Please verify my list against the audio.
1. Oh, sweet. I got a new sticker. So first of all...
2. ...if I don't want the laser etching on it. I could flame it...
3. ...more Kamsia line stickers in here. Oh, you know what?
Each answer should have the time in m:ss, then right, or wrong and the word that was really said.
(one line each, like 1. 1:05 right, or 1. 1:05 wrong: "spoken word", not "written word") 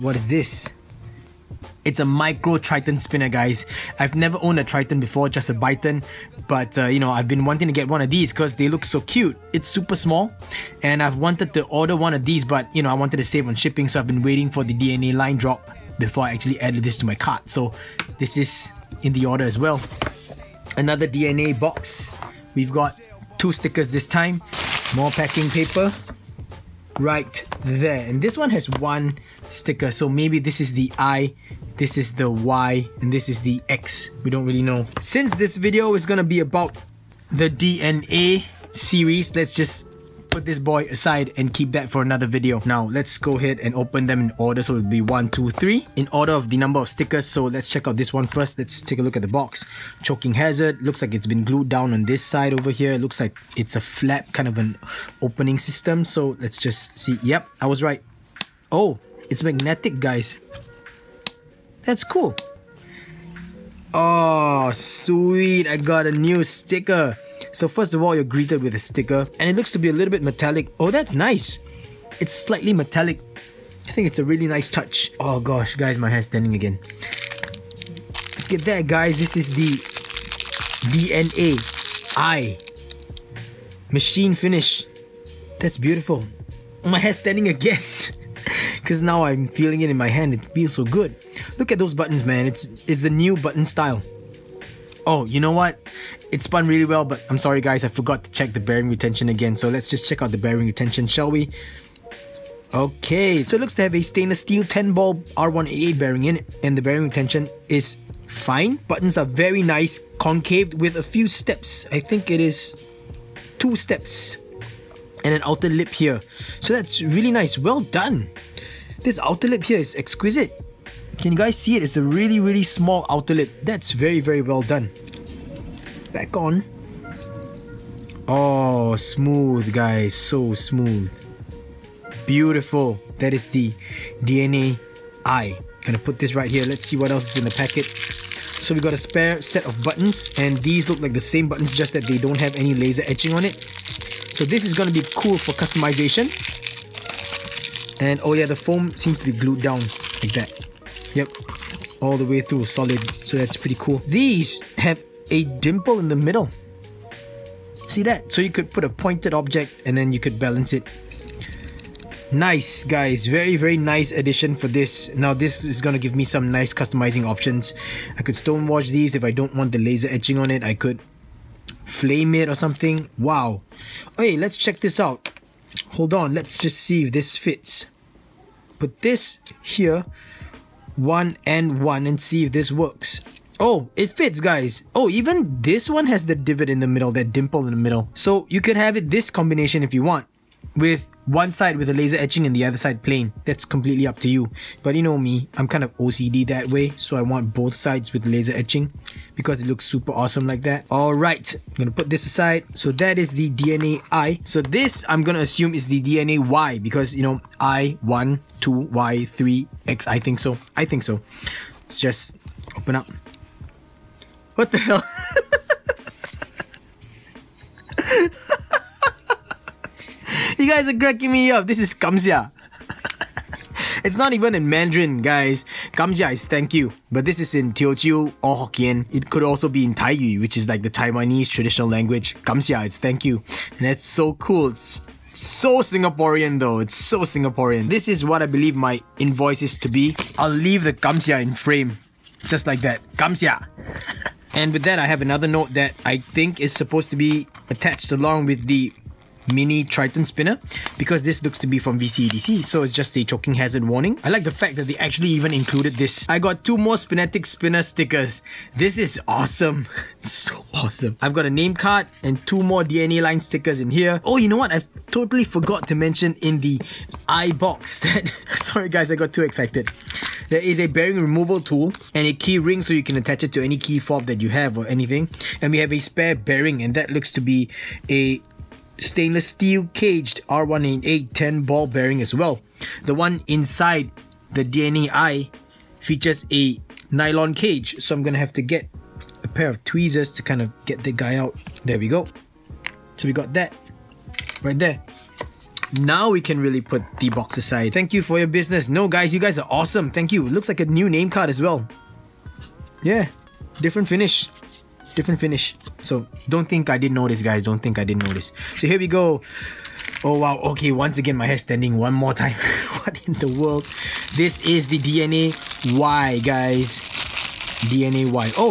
1. 1:03 right
2. 2:49 right
3. 4:22 wrong: "DNA", not "Kamsia".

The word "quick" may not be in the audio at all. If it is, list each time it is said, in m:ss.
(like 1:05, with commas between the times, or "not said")
not said.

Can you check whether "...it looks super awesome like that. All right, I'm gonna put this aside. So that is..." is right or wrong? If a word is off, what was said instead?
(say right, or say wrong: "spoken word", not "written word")
right.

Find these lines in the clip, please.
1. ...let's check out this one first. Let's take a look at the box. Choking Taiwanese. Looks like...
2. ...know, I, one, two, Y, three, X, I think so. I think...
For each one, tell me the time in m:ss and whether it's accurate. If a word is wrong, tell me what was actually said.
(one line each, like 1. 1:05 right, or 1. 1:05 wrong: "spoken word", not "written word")
1. 0:47 wrong: "Hazard", not "Taiwanese"
2. 3:27 right.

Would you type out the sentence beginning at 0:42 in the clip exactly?
Now, let's go ahead and open them in order.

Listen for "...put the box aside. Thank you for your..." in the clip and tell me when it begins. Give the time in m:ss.
4:56.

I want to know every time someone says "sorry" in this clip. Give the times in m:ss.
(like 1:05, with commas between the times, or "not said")
1:37, 4:28.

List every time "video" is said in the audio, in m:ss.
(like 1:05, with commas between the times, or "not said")
0:35, 0:42.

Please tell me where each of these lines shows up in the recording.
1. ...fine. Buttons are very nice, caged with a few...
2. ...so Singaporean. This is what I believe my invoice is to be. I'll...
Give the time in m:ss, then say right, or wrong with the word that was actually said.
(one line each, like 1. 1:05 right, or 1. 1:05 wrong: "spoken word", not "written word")
1. 1:48 wrong: "concaved", not "caged"
2. 3:56 right.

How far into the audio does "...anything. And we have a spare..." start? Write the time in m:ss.
4:34.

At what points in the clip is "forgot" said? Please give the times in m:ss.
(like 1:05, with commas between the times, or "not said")
1:37, 4:25.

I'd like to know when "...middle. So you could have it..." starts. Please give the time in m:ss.
3:07.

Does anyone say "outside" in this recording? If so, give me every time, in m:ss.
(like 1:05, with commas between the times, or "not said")
not said.